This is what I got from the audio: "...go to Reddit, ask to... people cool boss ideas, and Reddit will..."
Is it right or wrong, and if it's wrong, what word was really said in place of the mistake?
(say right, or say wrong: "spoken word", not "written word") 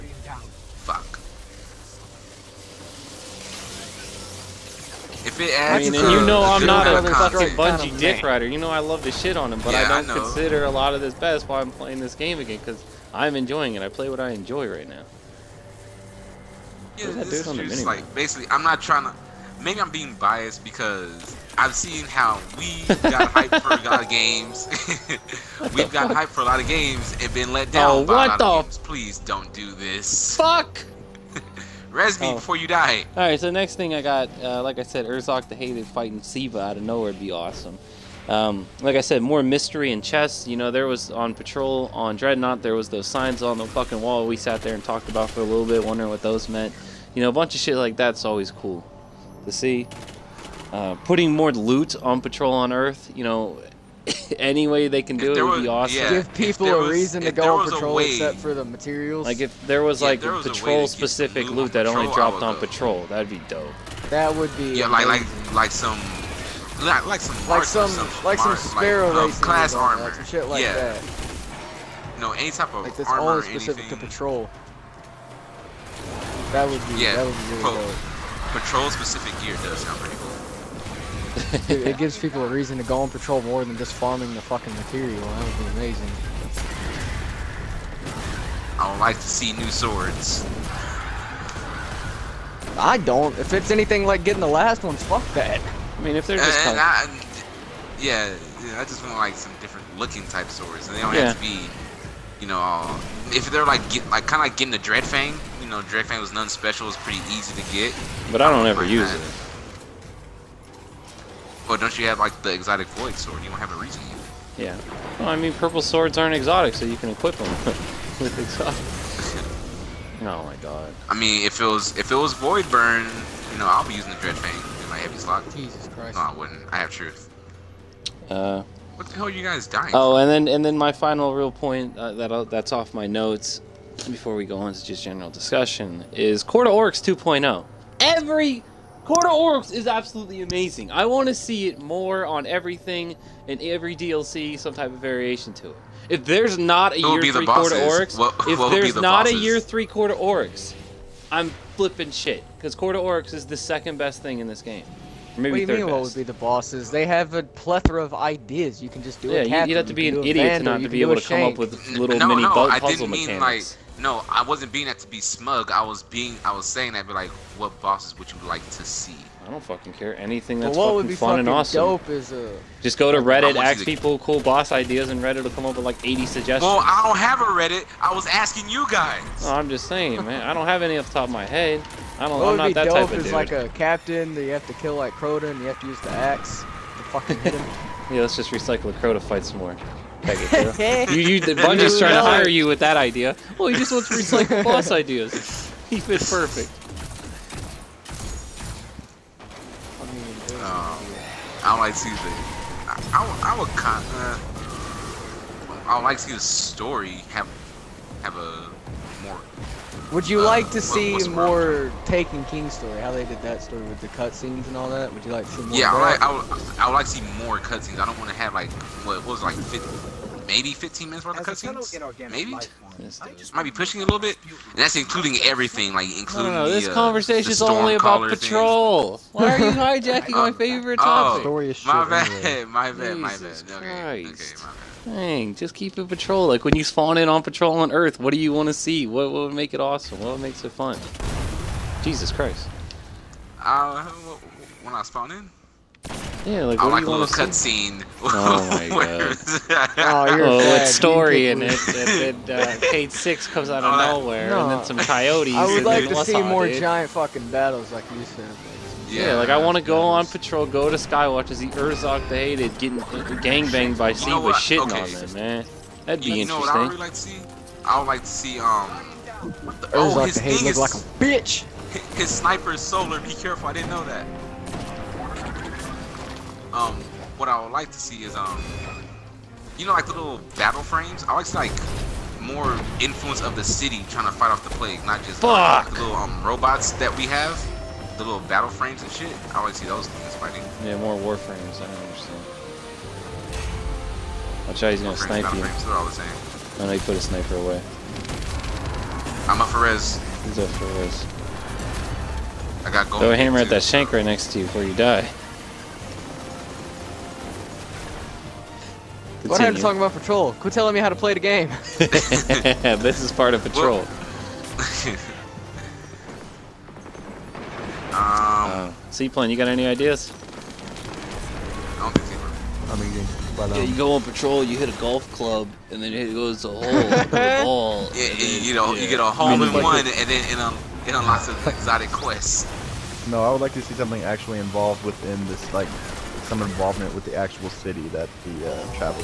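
right.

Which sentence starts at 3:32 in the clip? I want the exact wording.
How they did that story with the cutscenes and all that?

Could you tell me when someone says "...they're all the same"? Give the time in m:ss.
4:55.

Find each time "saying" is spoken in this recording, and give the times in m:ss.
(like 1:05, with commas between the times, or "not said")
2:46, 2:59.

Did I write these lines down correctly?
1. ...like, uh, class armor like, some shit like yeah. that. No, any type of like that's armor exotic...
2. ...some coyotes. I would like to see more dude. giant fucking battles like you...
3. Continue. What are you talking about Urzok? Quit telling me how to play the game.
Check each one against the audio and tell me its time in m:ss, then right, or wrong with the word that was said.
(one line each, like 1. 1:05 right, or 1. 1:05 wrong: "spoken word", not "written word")
1. 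1:09 wrong: "specific", not "exotic"
2. 4:14 right
3. 5:09 wrong: "Patrol", not "Urzok".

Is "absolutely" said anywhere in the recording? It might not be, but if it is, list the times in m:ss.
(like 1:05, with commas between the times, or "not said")
2:19.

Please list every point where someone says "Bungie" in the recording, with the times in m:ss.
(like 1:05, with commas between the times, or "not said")
0:07, 3:11.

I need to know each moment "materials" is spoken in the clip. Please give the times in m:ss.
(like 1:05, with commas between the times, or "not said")
0:58, 1:24.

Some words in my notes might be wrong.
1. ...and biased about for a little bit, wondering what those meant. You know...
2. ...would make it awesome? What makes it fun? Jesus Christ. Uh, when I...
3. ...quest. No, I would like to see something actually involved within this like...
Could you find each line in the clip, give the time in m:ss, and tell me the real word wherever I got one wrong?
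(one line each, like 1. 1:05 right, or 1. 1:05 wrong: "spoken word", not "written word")
1. 0:44 wrong: "talked", not "biased"
2. 3:59 right
3. 5:32 right.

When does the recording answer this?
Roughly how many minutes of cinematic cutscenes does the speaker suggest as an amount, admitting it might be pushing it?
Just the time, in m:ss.
3:40.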